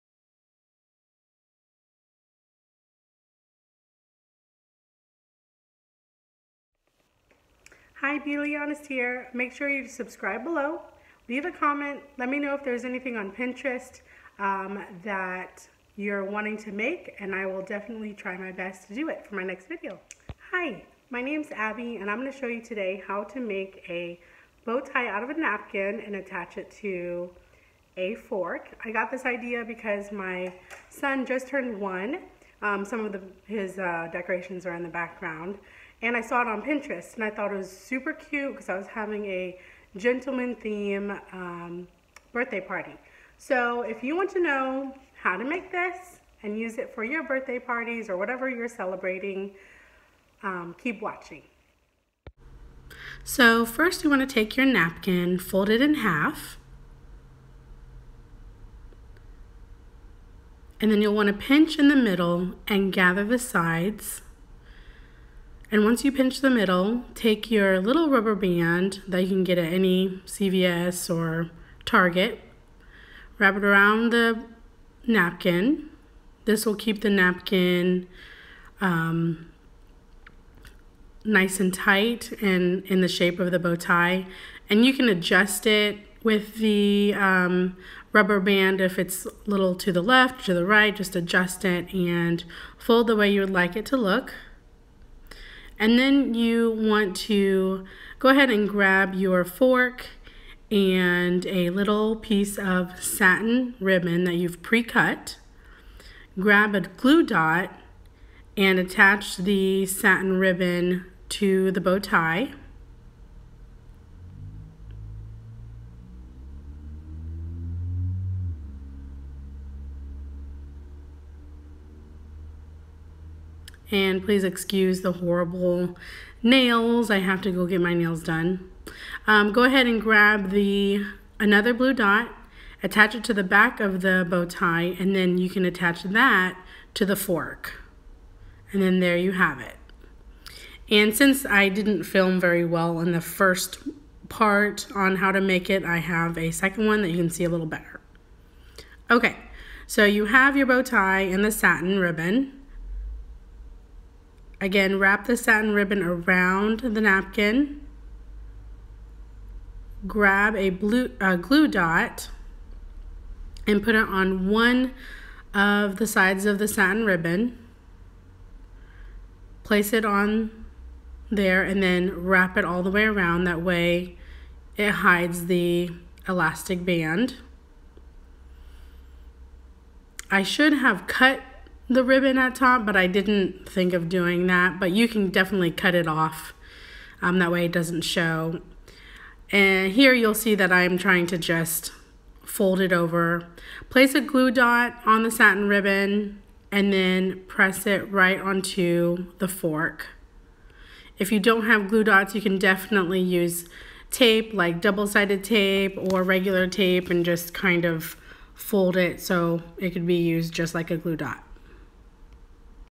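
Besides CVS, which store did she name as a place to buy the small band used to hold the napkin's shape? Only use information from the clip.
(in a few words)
Target.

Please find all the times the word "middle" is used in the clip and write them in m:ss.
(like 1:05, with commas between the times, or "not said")
1:01, 1:06.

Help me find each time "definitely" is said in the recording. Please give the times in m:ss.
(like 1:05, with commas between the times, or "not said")
0:17, 3:05, 3:22.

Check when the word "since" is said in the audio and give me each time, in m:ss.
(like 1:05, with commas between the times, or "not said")
2:21.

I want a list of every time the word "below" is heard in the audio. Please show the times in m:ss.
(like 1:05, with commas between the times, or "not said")
0:10.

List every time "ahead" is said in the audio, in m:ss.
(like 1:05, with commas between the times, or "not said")
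1:38, 2:09.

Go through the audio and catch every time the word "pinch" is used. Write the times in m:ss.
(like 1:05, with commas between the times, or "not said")
1:01, 1:06.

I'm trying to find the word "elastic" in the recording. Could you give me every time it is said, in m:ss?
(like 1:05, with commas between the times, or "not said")
2:56.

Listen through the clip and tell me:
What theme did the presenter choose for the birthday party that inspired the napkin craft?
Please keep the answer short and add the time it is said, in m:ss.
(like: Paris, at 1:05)
Gentleman theme, at 0:39.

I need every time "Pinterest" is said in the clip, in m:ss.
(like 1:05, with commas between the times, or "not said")
0:13, 0:36.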